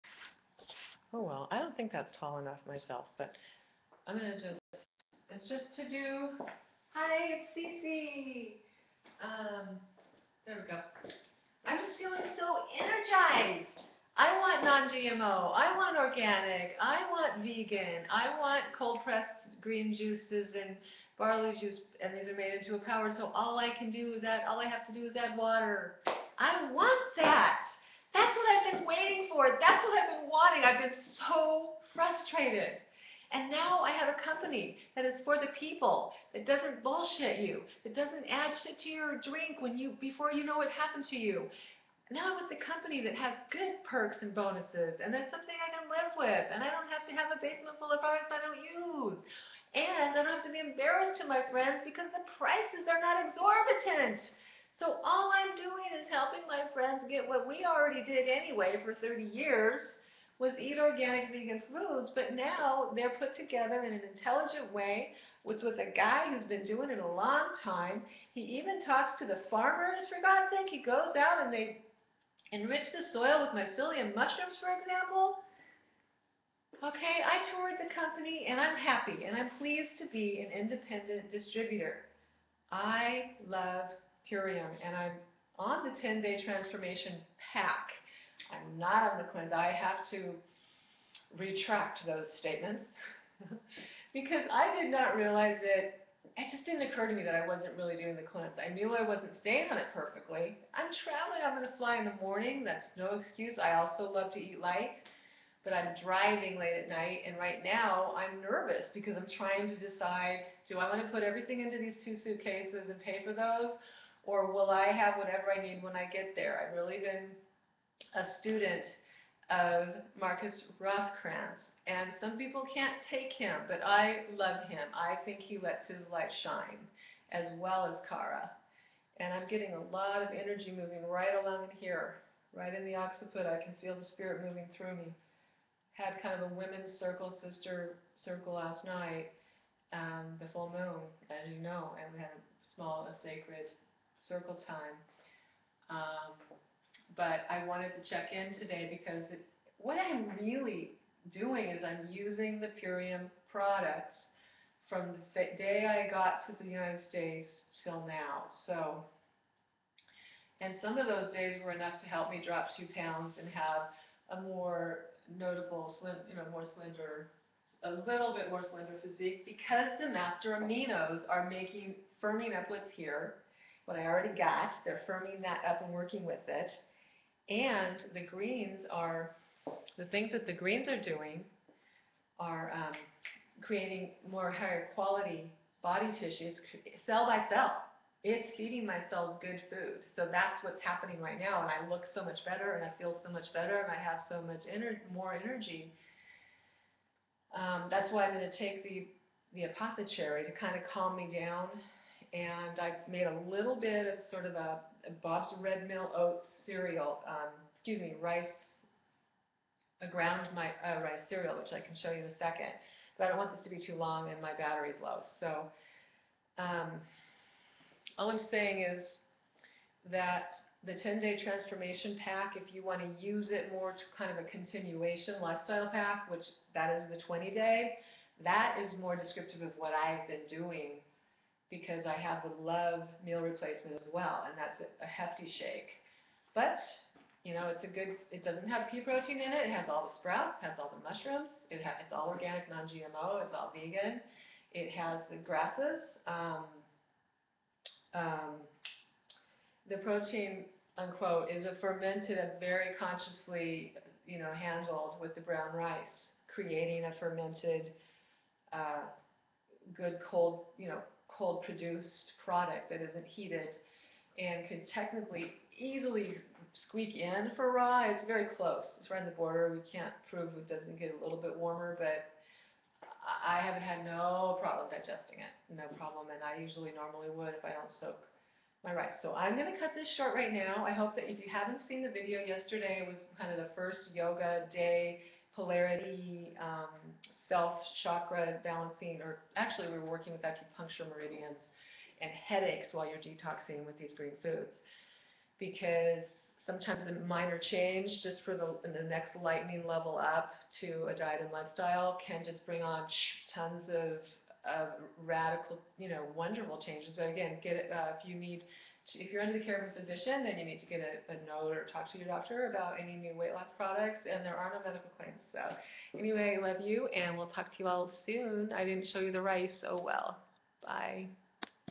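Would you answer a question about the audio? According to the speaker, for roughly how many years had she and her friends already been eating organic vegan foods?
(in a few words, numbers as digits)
30 years.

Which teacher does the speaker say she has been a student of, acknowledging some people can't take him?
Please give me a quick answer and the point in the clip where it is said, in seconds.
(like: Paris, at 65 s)
Markus Rothkranz, at 120 s.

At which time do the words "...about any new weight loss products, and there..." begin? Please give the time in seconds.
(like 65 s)
312 s.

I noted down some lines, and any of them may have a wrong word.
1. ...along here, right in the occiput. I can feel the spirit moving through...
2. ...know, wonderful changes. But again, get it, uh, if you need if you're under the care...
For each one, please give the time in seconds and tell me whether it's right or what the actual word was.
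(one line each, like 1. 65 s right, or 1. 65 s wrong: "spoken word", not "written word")
1. 131 s right
2. 306 s right.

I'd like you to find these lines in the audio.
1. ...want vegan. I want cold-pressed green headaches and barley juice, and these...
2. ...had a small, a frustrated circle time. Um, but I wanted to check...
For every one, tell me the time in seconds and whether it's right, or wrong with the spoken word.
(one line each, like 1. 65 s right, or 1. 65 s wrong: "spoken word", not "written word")
1. 17 s wrong: "juices", not "headaches"
2. 142 s wrong: "sacred", not "frustrated".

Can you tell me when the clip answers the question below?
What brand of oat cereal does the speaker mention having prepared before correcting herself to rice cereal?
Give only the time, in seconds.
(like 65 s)
205 s.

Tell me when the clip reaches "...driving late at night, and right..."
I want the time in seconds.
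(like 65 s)
106 s.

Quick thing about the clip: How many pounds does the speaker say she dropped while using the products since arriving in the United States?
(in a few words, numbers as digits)
2.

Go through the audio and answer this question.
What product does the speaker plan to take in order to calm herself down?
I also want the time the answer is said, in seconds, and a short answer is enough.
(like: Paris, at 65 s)
Apothe-Cherry, at 199 s.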